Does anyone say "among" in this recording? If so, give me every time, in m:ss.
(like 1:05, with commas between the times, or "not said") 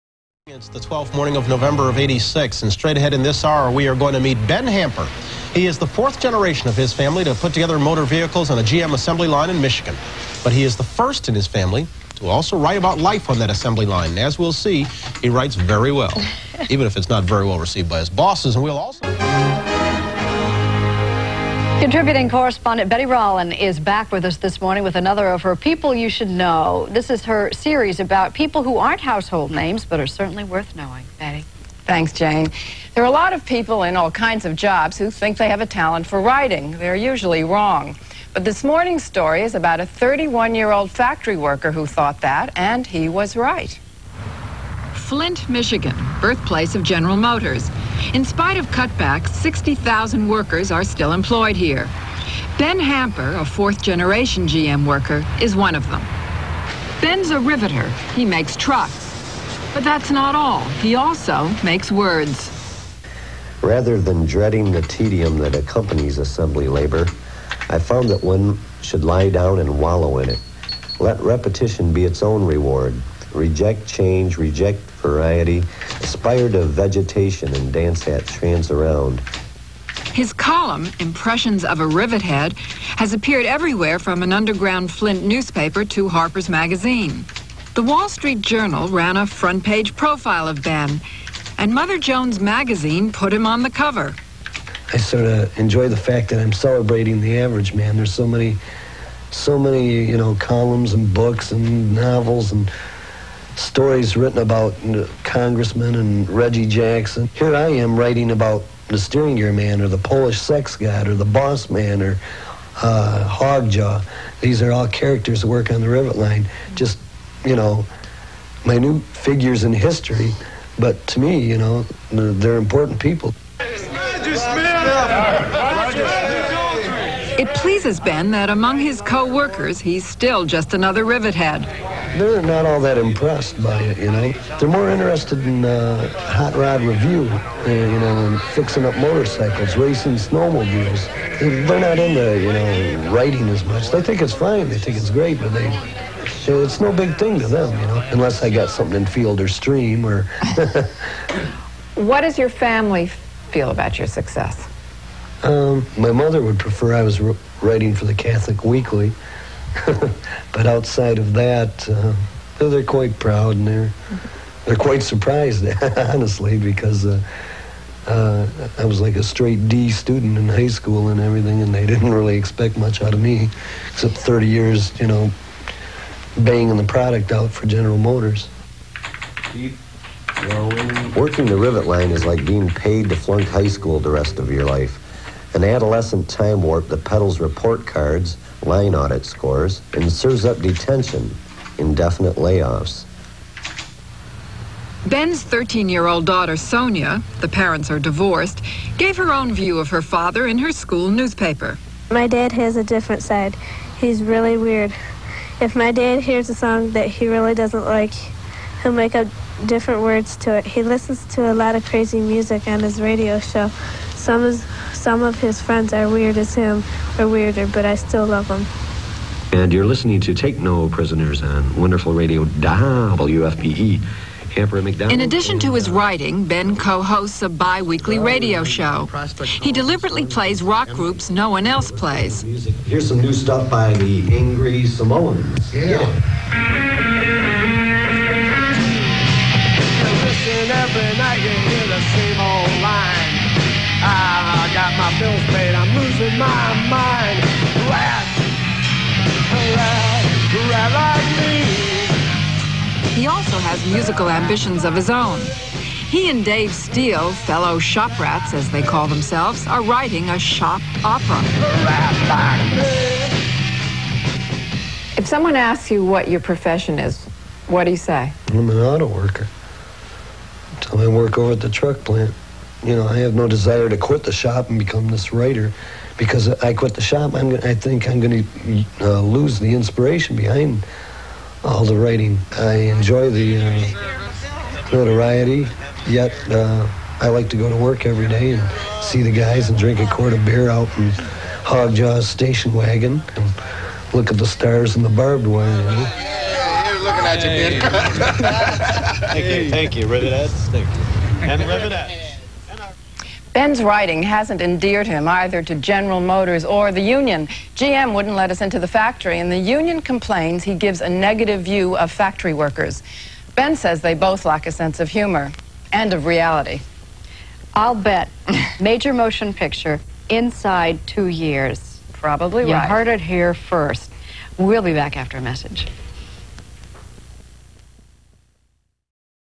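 2:08.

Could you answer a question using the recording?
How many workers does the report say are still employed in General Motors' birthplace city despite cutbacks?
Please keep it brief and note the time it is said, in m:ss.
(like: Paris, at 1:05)
60,000, at 0:49.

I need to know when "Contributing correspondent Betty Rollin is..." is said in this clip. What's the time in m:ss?
0:21.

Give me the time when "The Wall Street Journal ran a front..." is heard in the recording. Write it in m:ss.
1:27.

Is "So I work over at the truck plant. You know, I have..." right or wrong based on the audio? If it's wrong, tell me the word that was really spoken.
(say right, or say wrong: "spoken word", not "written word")
right.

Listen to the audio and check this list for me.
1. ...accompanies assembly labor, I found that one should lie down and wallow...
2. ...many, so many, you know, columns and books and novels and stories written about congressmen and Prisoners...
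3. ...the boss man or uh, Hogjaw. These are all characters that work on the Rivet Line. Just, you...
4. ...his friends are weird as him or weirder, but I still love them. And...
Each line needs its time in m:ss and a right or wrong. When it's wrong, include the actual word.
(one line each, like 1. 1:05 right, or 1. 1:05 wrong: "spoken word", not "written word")
1. 1:05 right
2. 1:38 wrong: "Reggie", not "Prisoners"
3. 1:51 right
4. 3:35 right.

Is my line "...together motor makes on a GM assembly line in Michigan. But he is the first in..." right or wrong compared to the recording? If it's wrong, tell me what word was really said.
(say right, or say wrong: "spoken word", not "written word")
wrong: "vehicles", not "makes".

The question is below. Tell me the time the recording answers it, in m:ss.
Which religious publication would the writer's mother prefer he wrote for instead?
2:38.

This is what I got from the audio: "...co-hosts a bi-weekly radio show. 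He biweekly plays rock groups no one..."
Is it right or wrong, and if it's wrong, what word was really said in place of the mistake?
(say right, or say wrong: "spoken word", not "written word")
wrong: "deliberately", not "biweekly".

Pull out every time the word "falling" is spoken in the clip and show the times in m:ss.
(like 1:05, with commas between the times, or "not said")
not said.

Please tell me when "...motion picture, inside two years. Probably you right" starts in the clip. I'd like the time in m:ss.
5:19.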